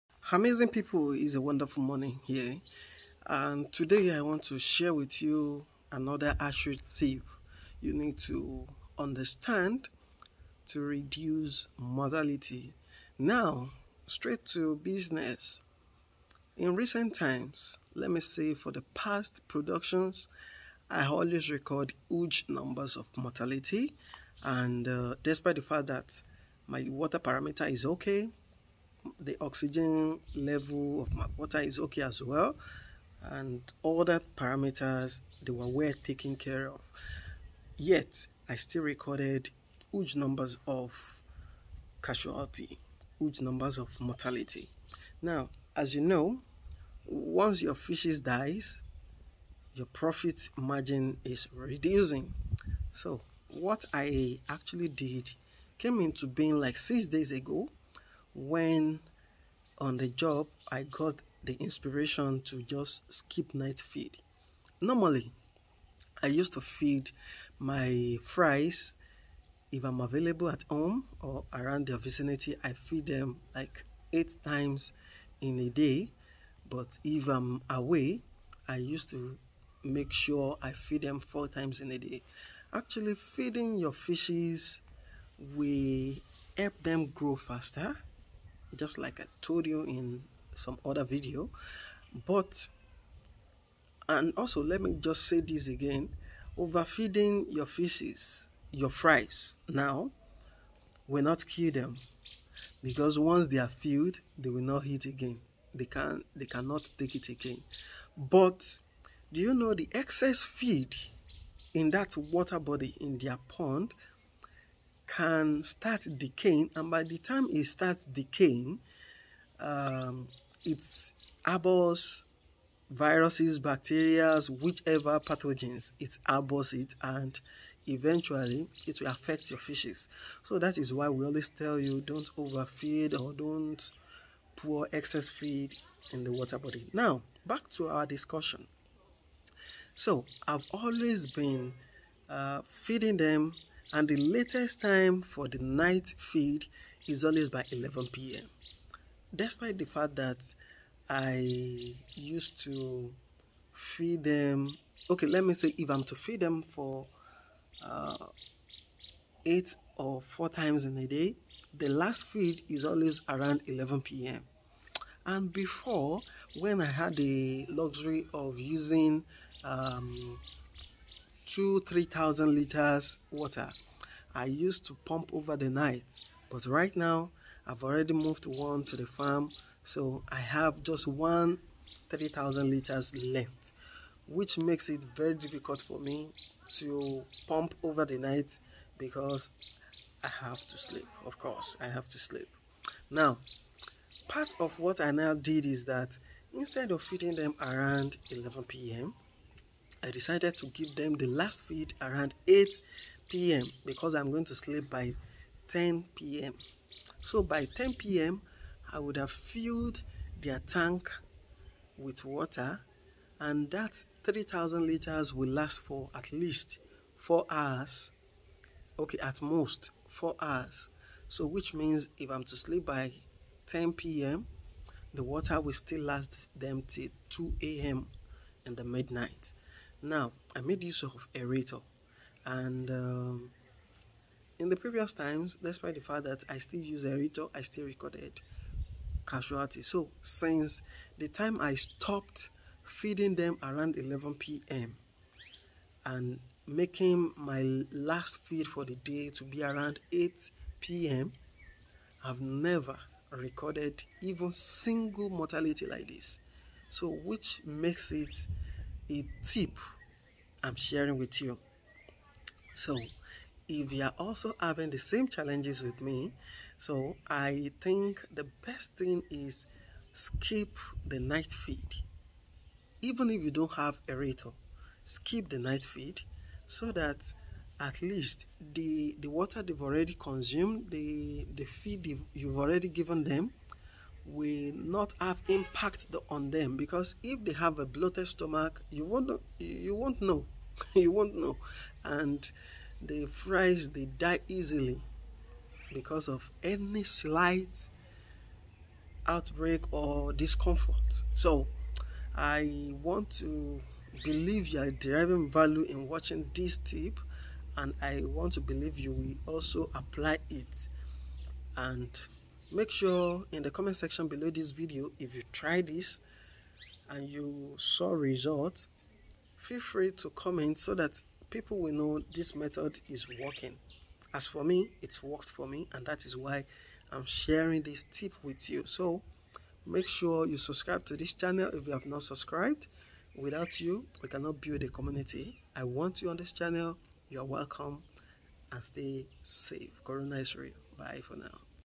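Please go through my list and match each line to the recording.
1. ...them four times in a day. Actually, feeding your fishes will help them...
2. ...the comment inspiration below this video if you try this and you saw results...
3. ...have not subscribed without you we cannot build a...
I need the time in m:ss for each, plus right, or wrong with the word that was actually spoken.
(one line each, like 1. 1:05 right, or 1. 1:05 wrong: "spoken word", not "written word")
1. 1:21 right
2. 5:13 wrong: "section", not "inspiration"
3. 5:31 right.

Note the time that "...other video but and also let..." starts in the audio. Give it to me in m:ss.
1:30.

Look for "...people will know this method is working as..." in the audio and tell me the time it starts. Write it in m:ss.
5:21.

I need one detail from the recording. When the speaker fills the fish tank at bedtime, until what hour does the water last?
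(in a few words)
2 a.m.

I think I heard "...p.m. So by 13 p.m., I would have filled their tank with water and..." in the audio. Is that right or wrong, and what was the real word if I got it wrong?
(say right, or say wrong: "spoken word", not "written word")
wrong: "10", not "13".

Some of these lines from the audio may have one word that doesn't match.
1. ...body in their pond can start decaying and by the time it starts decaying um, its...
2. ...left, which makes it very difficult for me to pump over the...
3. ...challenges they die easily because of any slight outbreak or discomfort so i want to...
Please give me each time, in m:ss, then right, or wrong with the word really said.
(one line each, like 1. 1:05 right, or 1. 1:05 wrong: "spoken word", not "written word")
1. 1:52 right
2. 3:03 right
3. 4:53 wrong: "fries", not "challenges".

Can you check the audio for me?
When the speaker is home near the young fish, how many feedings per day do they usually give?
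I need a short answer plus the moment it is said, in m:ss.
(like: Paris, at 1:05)
8, at 1:14.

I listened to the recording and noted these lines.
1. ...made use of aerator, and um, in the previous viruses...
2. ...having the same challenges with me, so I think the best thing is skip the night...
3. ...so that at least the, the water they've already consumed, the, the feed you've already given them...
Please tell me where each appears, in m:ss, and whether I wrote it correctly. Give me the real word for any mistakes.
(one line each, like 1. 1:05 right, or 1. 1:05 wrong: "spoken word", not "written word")
1. 3:50 wrong: "times", not "viruses"
2. 4:24 right
3. 4:36 right.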